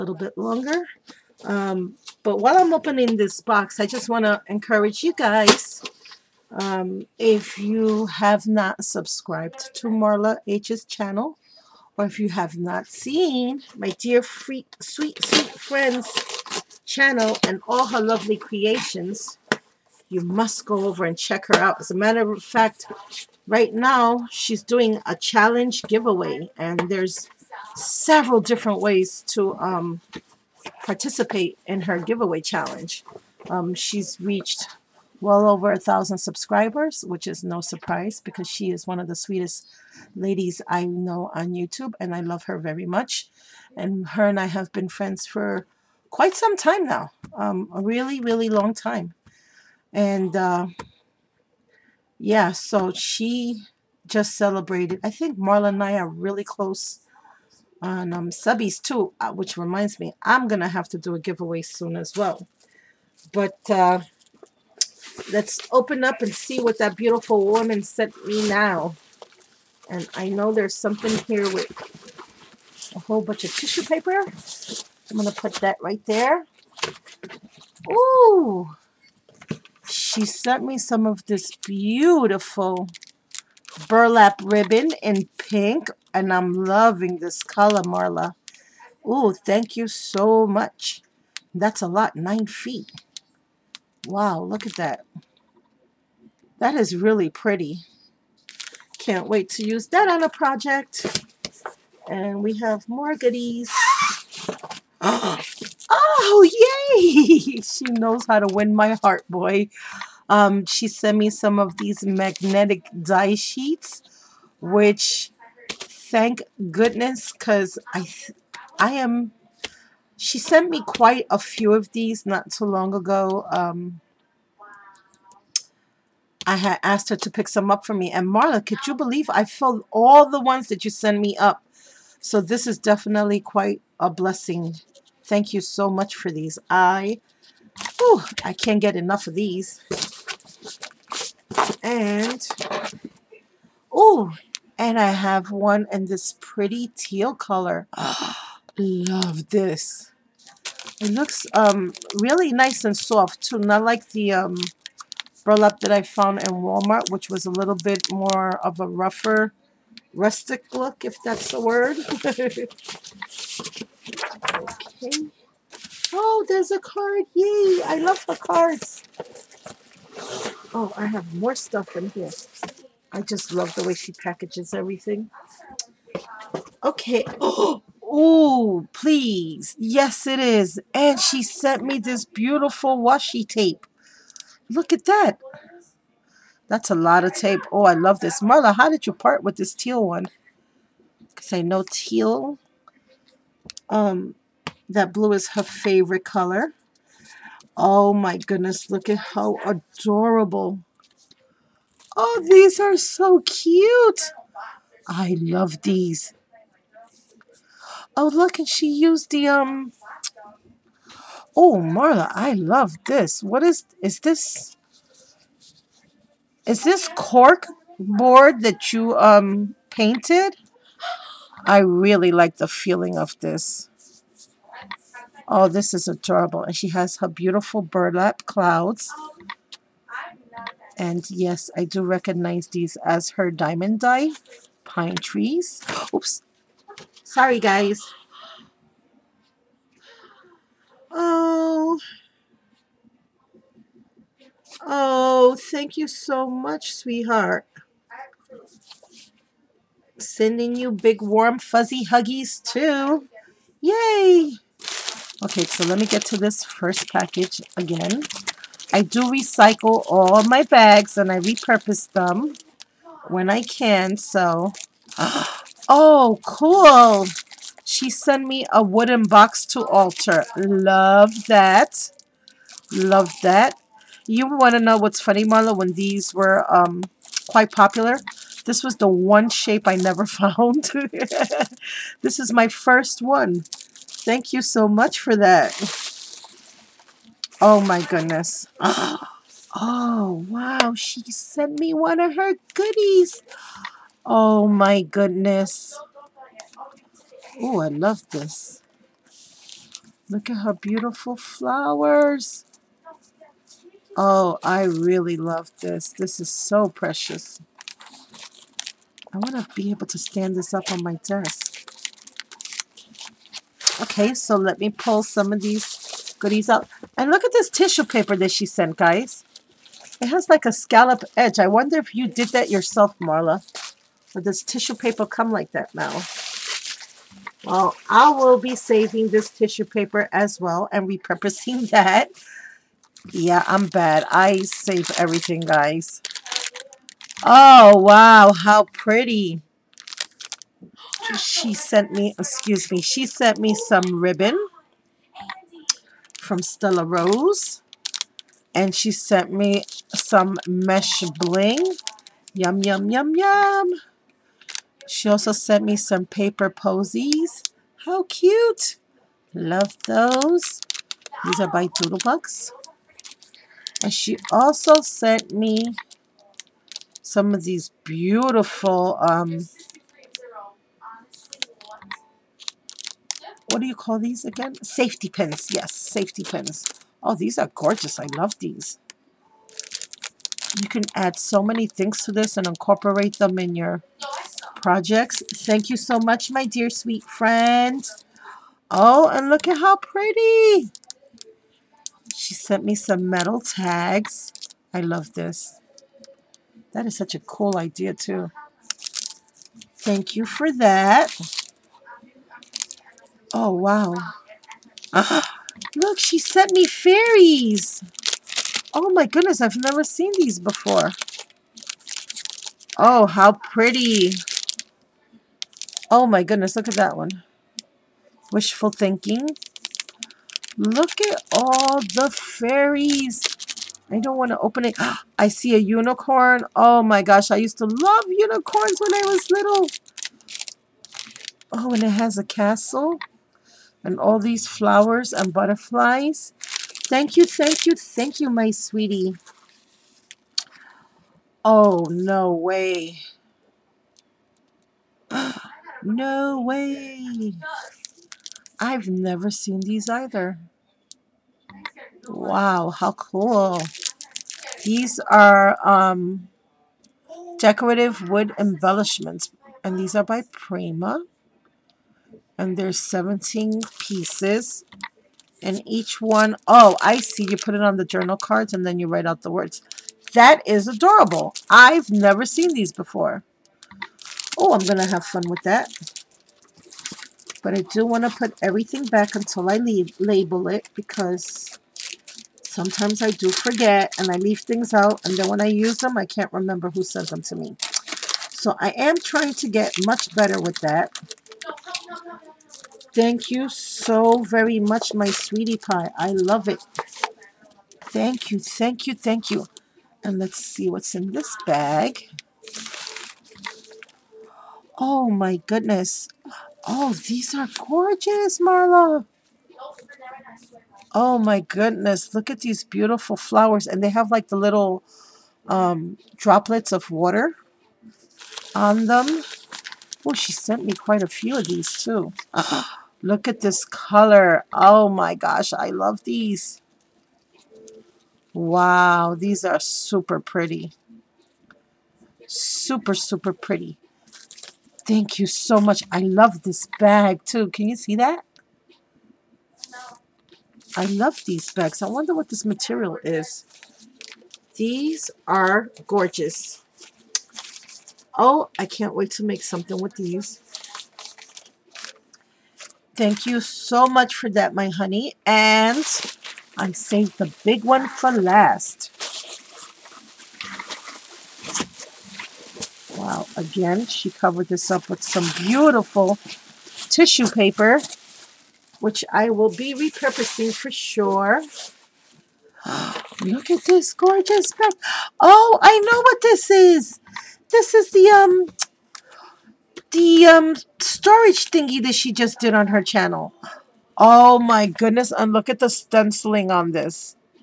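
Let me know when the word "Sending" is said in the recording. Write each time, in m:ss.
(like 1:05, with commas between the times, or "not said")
4:10.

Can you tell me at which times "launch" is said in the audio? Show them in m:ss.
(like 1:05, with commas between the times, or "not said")
not said.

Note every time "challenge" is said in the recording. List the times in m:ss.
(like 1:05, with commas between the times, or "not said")
0:25, 0:32.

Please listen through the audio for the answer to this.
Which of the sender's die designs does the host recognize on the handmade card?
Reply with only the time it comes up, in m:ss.
3:53.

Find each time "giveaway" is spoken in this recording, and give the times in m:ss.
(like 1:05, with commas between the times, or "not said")
0:25, 0:31, 1:01.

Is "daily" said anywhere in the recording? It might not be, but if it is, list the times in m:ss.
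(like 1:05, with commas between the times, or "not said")
not said.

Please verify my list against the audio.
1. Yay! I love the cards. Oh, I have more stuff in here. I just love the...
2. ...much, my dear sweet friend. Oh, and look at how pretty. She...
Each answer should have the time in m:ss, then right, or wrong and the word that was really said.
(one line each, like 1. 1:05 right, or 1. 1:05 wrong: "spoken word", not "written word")
1. 2:47 right
2. 6:26 right.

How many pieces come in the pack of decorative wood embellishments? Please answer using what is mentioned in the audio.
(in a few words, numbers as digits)
17.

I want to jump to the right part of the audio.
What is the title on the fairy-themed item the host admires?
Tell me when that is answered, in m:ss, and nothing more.
6:58.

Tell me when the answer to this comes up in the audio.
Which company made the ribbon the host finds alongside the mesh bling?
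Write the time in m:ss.
5:46.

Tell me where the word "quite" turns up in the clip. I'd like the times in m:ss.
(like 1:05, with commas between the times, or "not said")
0:46, 2:00, 2:13, 4:37, 8:40.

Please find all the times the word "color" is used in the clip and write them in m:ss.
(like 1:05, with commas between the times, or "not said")
1:27, 2:27, 3:16, 8:43.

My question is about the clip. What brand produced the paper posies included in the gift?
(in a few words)
Doodlebugs.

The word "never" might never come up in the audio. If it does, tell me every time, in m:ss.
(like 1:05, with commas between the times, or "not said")
4:39, 6:49, 7:29, 7:52.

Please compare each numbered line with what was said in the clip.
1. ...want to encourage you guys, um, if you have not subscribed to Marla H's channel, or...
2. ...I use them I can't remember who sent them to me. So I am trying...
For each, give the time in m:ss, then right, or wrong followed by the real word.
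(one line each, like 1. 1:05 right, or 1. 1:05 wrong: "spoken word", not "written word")
1. 0:04 right
2. 8:05 right.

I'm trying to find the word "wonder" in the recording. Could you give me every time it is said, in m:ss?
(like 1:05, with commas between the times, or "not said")
5:21, 9:02.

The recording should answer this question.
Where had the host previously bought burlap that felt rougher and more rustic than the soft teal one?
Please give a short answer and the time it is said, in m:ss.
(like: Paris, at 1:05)
Walmart, at 2:36.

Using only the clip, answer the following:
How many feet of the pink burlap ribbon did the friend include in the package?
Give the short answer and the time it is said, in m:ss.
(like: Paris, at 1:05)
9, at 1:32.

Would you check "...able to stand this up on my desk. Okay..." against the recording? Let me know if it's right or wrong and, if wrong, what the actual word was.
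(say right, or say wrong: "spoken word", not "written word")
right.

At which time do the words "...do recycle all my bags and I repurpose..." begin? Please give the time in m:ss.
4:19.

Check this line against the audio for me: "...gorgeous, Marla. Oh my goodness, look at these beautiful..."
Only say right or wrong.
right.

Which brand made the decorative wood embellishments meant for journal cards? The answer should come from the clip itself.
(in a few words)
Prima.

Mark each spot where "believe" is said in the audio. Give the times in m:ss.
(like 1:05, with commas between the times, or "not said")
2:08.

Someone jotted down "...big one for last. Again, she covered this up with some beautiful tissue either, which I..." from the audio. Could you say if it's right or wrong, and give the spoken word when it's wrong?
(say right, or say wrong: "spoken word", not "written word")
wrong: "paper", not "either".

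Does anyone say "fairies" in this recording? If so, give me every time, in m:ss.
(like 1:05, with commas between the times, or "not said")
6:46, 7:02.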